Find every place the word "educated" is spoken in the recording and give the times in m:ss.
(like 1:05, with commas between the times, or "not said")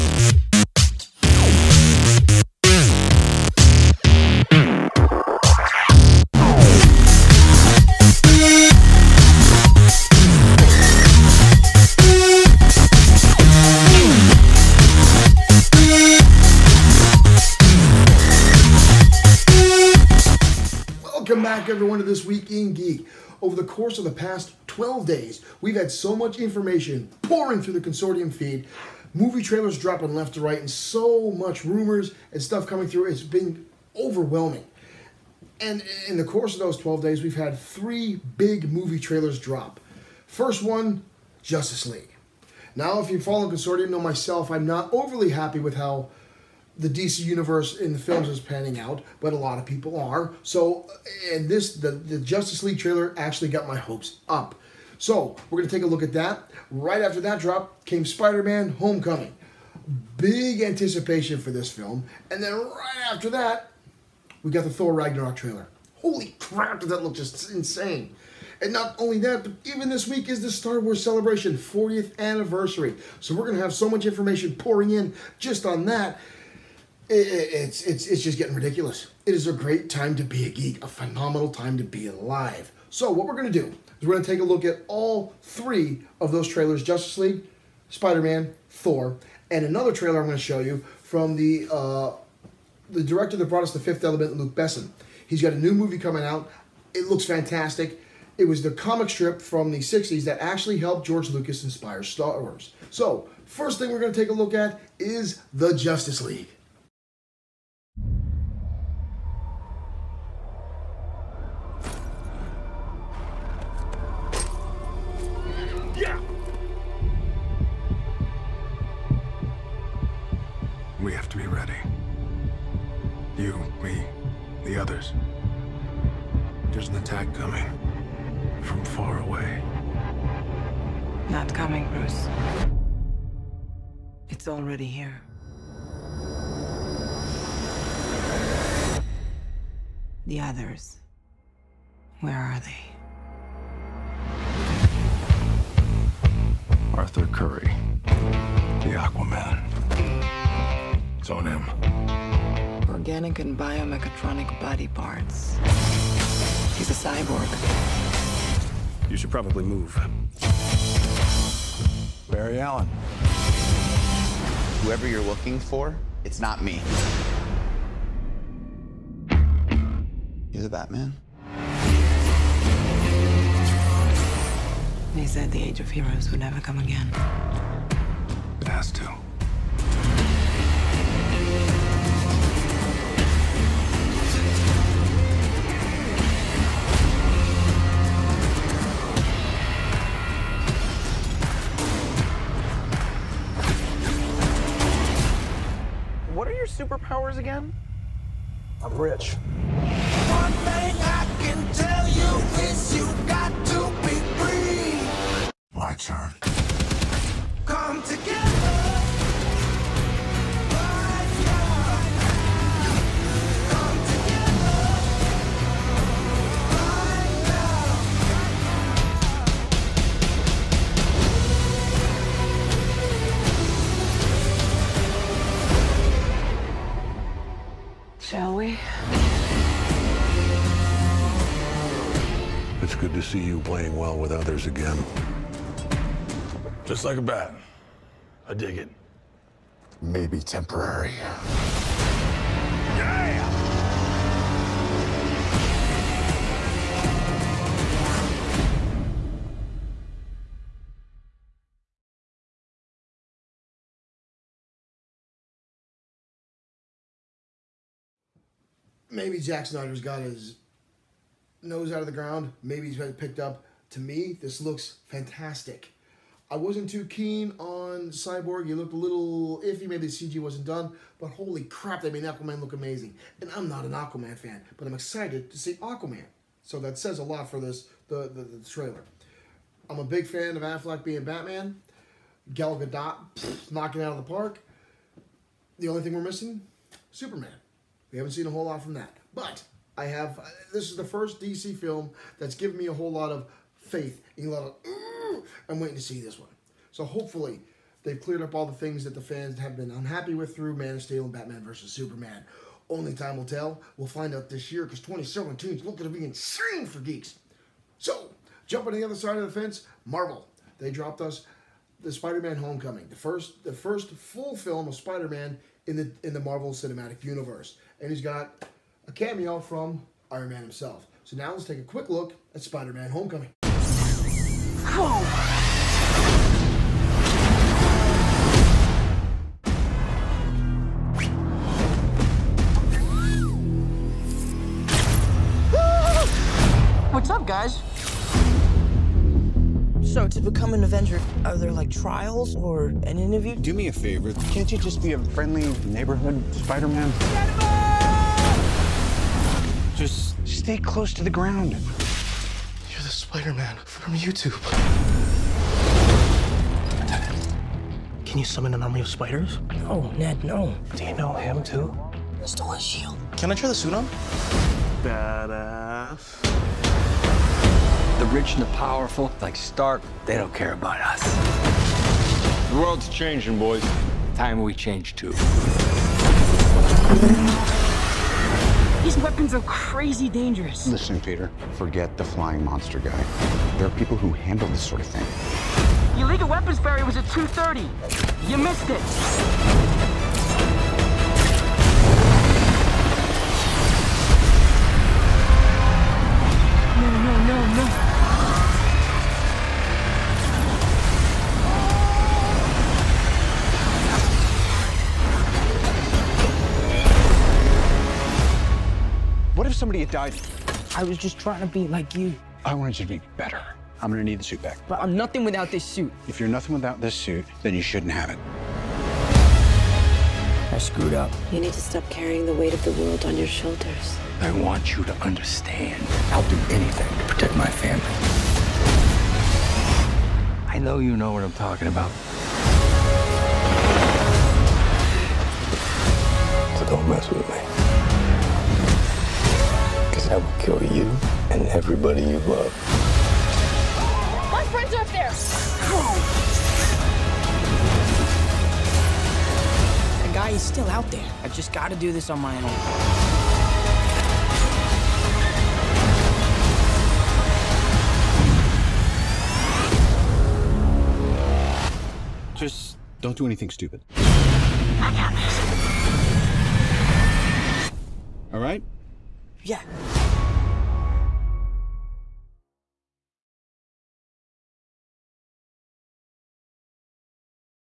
not said.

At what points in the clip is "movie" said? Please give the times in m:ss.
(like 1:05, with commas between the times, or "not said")
0:29, 0:38, 1:35.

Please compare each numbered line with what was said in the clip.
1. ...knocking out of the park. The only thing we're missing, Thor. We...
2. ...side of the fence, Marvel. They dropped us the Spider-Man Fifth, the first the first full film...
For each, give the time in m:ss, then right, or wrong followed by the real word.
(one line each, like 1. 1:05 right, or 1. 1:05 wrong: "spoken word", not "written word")
1. 4:43 wrong: "Superman", not "Thor"
2. 5:09 wrong: "Homecoming", not "Fifth".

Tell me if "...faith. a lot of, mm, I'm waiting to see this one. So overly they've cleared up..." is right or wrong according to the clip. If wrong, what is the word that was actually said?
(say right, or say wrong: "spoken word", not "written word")
wrong: "hopefully", not "overly".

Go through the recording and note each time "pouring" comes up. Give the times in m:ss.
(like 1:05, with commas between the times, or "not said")
0:27, 1:14.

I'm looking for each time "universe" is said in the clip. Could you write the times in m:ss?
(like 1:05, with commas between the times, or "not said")
0:47, 5:17.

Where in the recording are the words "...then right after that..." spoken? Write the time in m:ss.
1:02.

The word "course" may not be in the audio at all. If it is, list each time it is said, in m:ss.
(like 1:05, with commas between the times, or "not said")
0:23, 0:36.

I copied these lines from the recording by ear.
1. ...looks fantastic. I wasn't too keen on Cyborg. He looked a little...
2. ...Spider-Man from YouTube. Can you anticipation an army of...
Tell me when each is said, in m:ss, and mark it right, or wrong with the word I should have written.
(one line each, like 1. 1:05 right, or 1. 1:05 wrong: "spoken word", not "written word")
1. 4:24 right
2. 5:53 wrong: "summon", not "anticipation".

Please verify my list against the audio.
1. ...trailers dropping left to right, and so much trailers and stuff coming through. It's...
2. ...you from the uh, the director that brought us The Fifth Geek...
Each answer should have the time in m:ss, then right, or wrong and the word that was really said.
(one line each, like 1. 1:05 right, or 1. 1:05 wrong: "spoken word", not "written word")
1. 0:29 wrong: "rumors", not "trailers"
2. 1:30 wrong: "Element", not "Geek".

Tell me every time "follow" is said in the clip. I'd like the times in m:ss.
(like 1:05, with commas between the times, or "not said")
0:43.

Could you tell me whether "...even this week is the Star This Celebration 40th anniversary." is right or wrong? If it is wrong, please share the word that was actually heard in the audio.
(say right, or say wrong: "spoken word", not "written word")
wrong: "Wars", not "This".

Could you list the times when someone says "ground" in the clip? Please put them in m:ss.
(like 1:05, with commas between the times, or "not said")
4:22, 5:51.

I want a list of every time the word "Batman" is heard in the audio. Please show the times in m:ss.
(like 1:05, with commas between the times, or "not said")
2:50, 4:41, 5:01.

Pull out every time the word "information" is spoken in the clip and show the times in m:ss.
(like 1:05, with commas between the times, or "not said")
0:26, 1:14.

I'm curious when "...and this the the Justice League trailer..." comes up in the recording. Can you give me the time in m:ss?
0:51.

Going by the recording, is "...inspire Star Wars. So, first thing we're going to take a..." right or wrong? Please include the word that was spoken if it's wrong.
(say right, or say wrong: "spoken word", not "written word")
right.